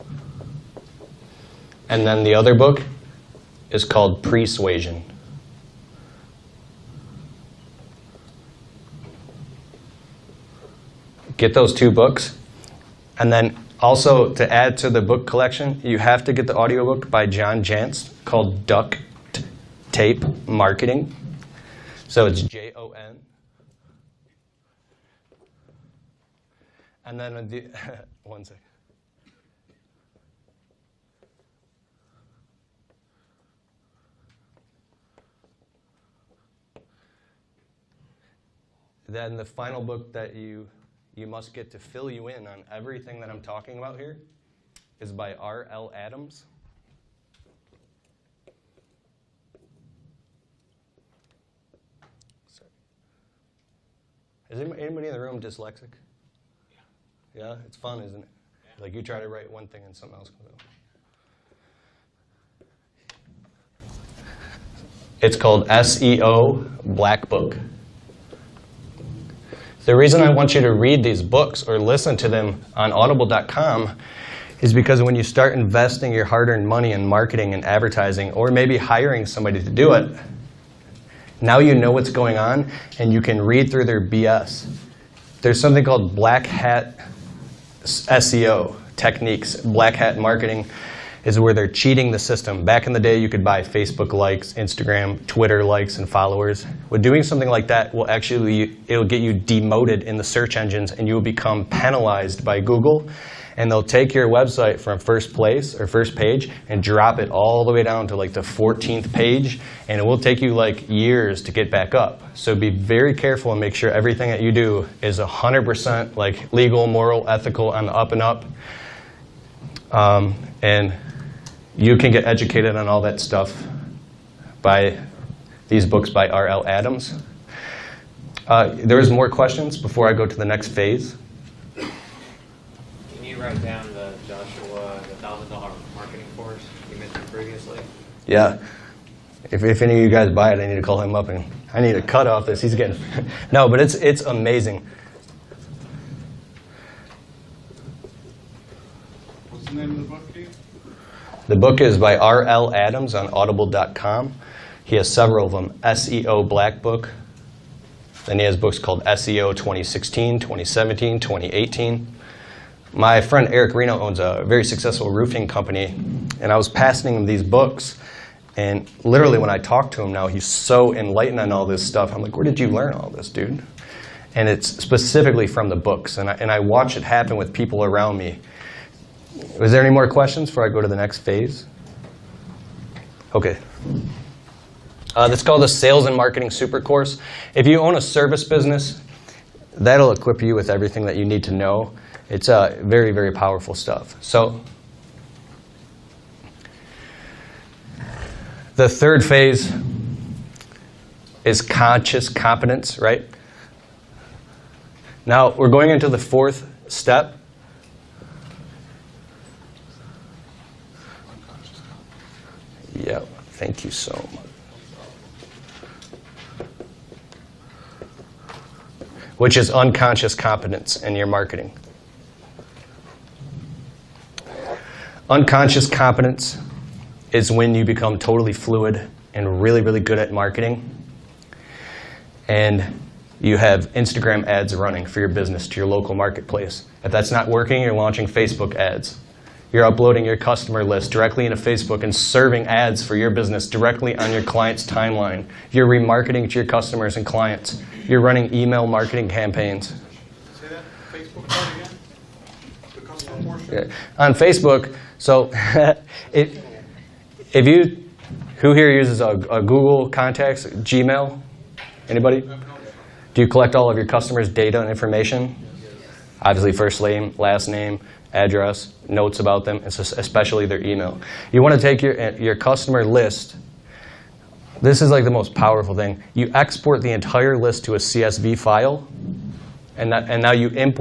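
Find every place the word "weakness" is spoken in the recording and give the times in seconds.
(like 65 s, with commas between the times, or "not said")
not said.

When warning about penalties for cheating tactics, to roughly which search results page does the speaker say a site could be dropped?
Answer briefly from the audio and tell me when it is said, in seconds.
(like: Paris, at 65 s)
14th page, at 108 s.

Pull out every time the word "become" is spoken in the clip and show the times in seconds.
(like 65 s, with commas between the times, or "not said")
101 s, 227 s.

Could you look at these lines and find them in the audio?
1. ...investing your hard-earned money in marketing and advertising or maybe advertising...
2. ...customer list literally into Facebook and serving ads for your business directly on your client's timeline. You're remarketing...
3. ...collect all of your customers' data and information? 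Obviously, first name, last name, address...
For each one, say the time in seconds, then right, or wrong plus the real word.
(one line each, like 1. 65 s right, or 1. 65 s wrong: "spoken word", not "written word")
1. 75 s wrong: "hiring", not "advertising"
2. 240 s wrong: "directly", not "literally"
3. 263 s right.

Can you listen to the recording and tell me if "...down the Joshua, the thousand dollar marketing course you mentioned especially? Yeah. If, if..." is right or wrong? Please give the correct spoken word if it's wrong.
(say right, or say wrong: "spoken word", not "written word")
wrong: "previously", not "especially".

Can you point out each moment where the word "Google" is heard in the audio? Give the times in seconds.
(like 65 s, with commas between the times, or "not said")
102 s, 259 s.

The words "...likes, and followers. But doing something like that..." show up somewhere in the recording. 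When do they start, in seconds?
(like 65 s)
95 s.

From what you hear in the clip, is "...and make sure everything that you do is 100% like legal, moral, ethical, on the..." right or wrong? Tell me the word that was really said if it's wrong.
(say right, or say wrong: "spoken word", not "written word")
right.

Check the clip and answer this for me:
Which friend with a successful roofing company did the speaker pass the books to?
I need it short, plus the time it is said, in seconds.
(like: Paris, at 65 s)
Eric Reno, at 163 s.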